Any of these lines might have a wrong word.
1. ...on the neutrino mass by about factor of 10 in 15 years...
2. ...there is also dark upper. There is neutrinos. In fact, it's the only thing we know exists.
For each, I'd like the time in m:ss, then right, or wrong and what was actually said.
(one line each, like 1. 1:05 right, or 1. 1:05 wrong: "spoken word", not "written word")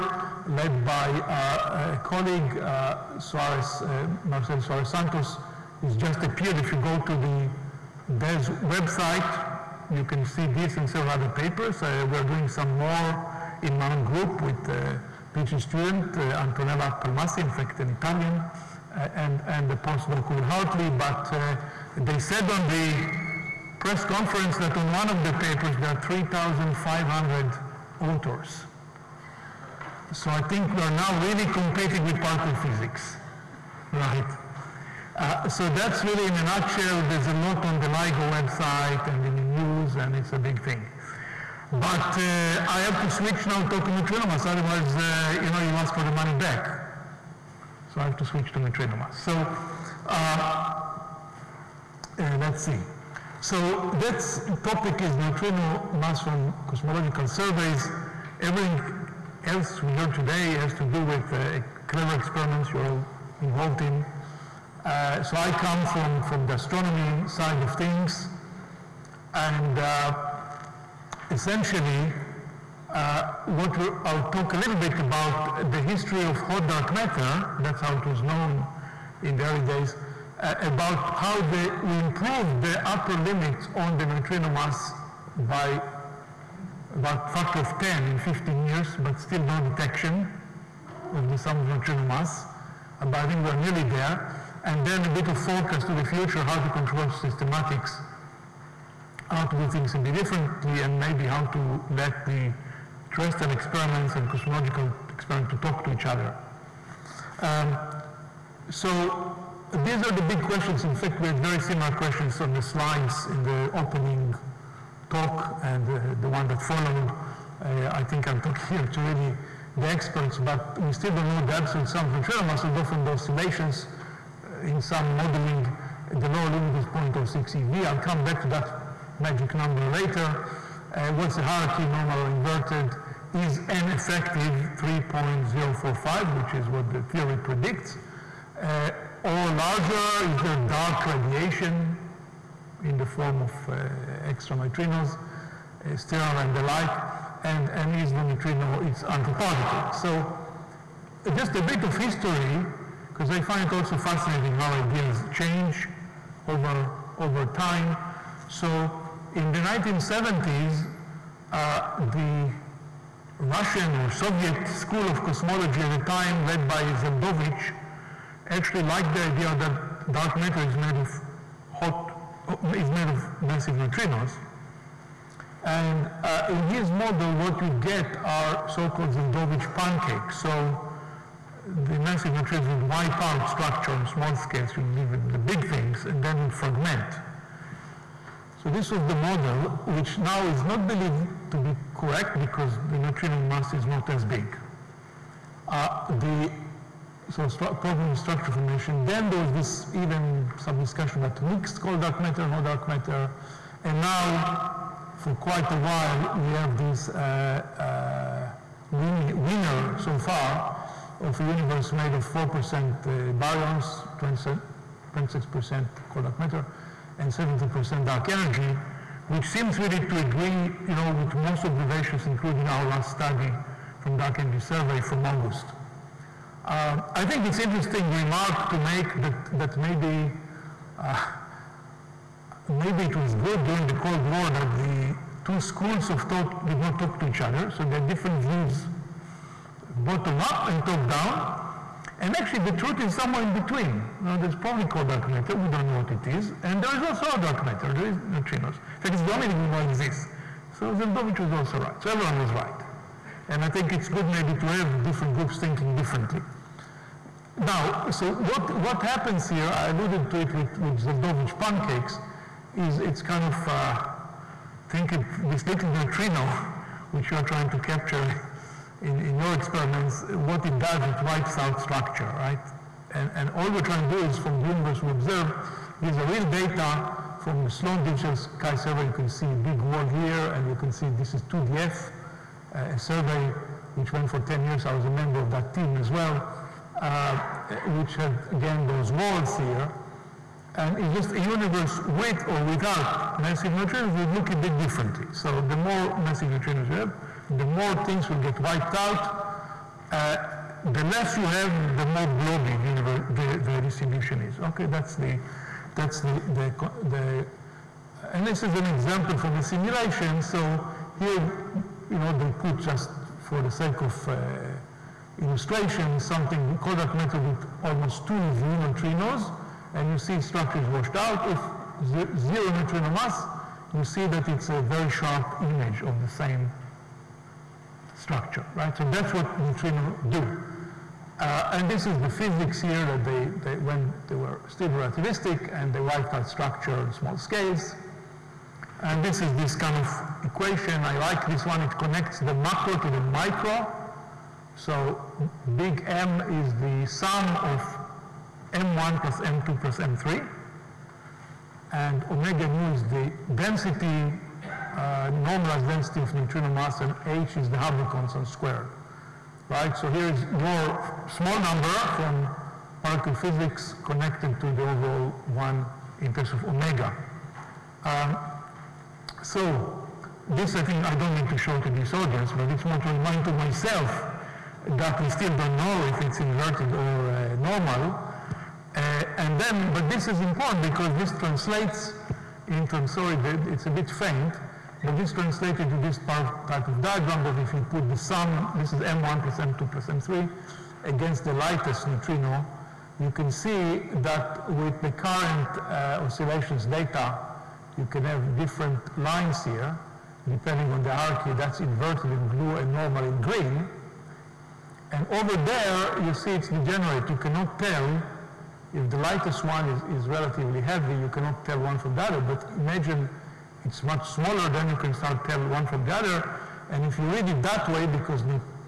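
1. 1:23 right
2. 4:06 wrong: "matter", not "upper".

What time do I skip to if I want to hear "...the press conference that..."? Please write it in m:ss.
0:22.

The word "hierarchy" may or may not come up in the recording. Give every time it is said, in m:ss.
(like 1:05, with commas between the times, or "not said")
2:11, 6:41.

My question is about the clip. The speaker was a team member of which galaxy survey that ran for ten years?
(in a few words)
2DF.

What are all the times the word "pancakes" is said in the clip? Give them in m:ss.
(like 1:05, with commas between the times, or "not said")
2:59, 4:21.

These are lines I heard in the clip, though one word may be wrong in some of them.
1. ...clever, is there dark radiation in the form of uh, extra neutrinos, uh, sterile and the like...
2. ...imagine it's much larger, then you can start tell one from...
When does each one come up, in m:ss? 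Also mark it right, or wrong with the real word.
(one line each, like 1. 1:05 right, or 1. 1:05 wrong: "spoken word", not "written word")
1. 2:19 wrong: "larger", not "clever"
2. 6:52 wrong: "smaller", not "larger".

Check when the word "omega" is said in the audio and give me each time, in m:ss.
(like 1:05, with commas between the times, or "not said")
5:52, 6:06.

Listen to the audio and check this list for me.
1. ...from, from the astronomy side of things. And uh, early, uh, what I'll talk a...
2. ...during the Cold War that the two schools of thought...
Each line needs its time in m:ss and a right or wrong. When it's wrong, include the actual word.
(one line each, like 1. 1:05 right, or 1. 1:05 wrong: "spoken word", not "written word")
1. 1:05 wrong: "essentially", not "early"
2. 3:53 right.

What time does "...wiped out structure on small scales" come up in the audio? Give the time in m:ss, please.
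5:36.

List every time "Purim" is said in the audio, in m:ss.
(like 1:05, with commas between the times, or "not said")
not said.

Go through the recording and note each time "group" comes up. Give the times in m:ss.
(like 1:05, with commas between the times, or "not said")
0:14, 4:15.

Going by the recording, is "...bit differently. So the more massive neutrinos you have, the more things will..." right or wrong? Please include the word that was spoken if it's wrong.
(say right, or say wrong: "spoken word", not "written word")
right.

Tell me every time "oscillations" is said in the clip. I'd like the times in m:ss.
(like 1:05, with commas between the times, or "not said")
2:03, 6:36.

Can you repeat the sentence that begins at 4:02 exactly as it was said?
And actually, the truth is somewhere in between.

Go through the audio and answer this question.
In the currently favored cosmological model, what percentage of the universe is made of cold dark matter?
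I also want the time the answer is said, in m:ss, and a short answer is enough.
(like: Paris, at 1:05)
26%, at 3:35.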